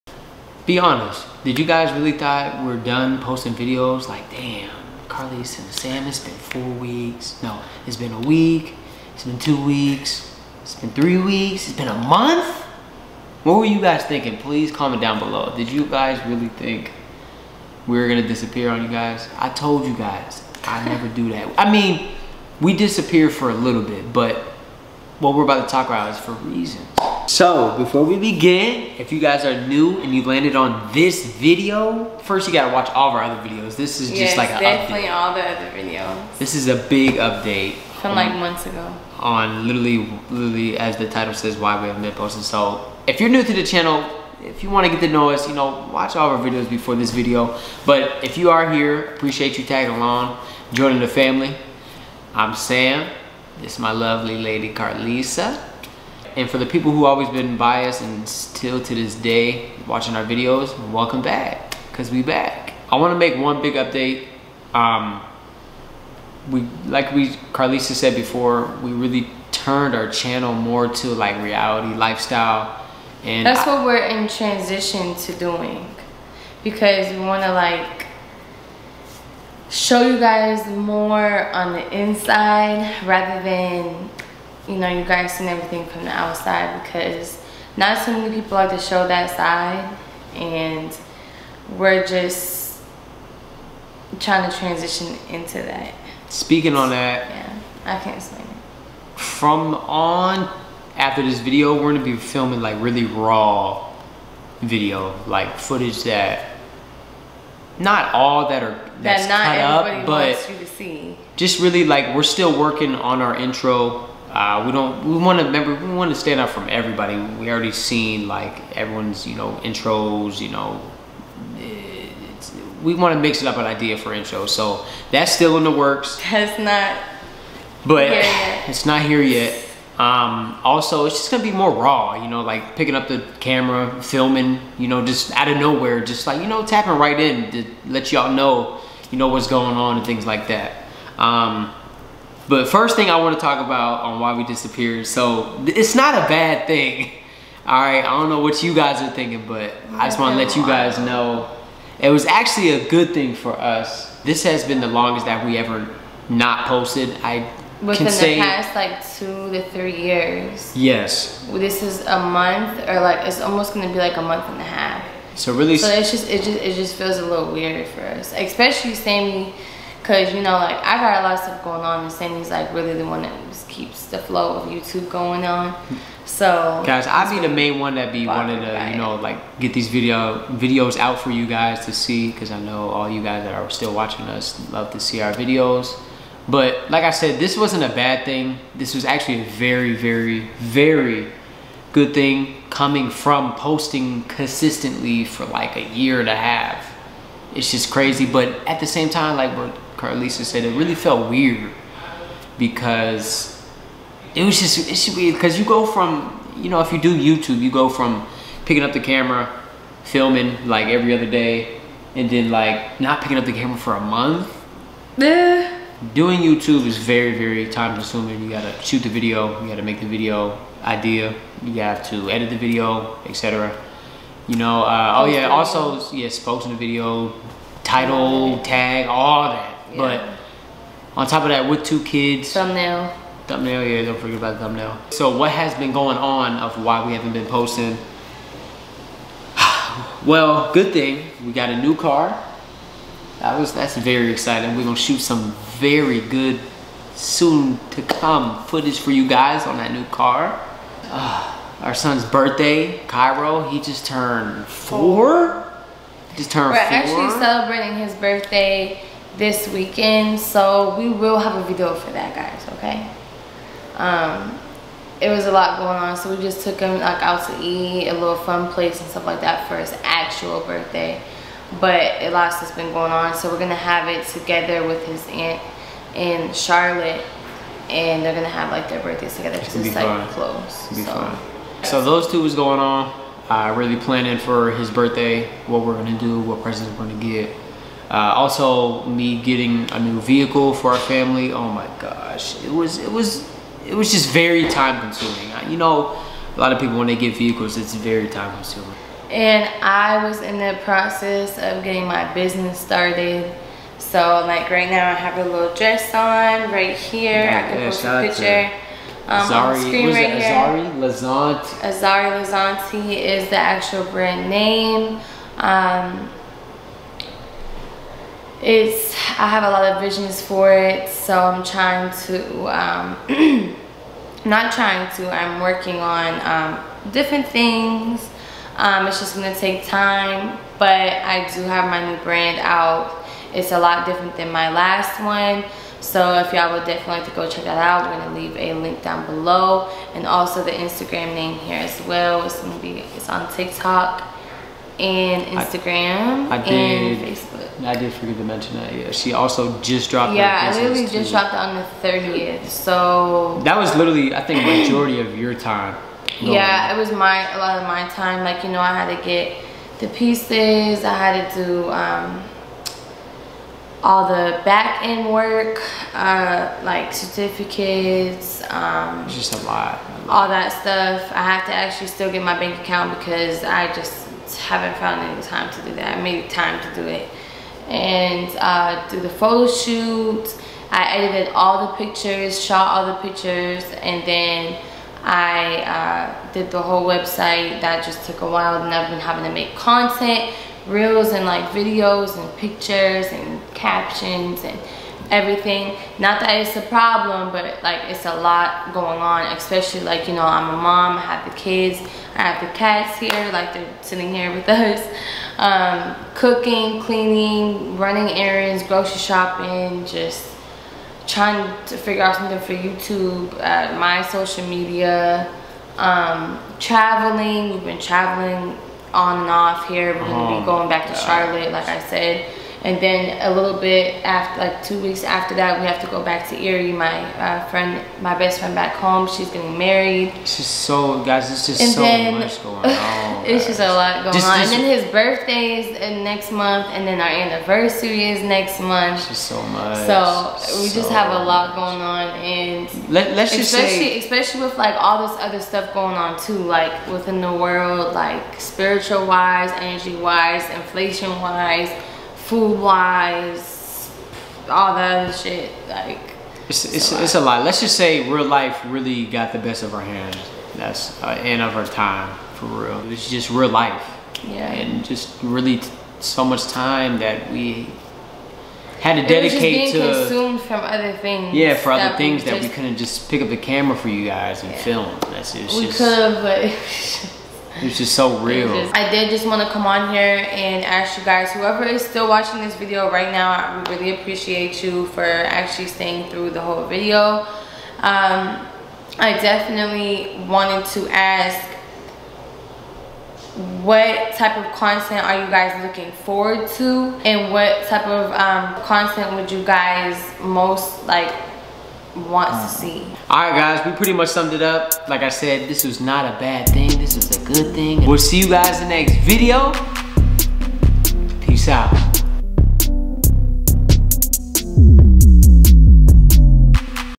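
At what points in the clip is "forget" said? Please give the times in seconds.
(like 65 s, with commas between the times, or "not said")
234 s, 348 s.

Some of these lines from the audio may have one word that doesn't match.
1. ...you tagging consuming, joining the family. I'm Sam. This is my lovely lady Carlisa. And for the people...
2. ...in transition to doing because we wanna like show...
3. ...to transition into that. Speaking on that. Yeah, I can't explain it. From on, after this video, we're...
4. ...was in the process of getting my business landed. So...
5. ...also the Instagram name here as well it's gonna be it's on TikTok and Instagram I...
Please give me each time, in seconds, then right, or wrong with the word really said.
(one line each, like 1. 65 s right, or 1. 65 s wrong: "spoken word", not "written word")
1. 49 s wrong: "along", not "consuming"
2. 74 s right
3. 94 s right
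4. 300 s wrong: "started", not "landed"
5. 340 s right.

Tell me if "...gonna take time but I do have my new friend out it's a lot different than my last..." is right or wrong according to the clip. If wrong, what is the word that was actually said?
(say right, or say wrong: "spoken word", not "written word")
wrong: "brand", not "friend".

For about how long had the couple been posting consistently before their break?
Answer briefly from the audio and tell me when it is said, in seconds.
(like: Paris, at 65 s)
a year and a half, at 195 s.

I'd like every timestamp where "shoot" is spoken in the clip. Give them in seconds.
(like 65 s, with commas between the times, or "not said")
218 s, 244 s, 379 s.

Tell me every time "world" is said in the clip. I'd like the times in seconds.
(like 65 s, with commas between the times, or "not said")
447 s.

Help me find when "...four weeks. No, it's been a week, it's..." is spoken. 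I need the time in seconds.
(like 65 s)
6 s.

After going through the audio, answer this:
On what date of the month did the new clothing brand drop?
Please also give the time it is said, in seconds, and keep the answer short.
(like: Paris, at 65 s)
the 30th, at 351 s.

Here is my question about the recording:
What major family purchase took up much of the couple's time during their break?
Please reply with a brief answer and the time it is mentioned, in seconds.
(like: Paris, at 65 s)
a new car, at 241 s.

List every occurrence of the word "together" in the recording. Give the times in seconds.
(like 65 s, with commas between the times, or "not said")
274 s, 279 s.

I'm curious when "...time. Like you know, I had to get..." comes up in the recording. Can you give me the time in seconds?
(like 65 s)
358 s.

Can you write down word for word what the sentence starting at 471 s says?
Yeah, for other things that we couldn't just pick up the camera for you guys and yeah.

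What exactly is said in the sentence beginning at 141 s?
Um, but first thing I want to talk about on why we disappeared.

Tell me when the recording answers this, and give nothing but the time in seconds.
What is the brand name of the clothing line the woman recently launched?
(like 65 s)
311 s.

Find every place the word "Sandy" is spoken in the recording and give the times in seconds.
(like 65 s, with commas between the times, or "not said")
172 s.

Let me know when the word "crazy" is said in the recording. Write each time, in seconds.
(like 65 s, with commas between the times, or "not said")
197 s.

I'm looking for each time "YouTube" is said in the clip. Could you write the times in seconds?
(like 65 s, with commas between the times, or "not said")
174 s, 207 s, 216 s, 412 s.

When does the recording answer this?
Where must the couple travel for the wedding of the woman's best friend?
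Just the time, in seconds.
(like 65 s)
426 s.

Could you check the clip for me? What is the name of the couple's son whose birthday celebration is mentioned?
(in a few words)
Cairo.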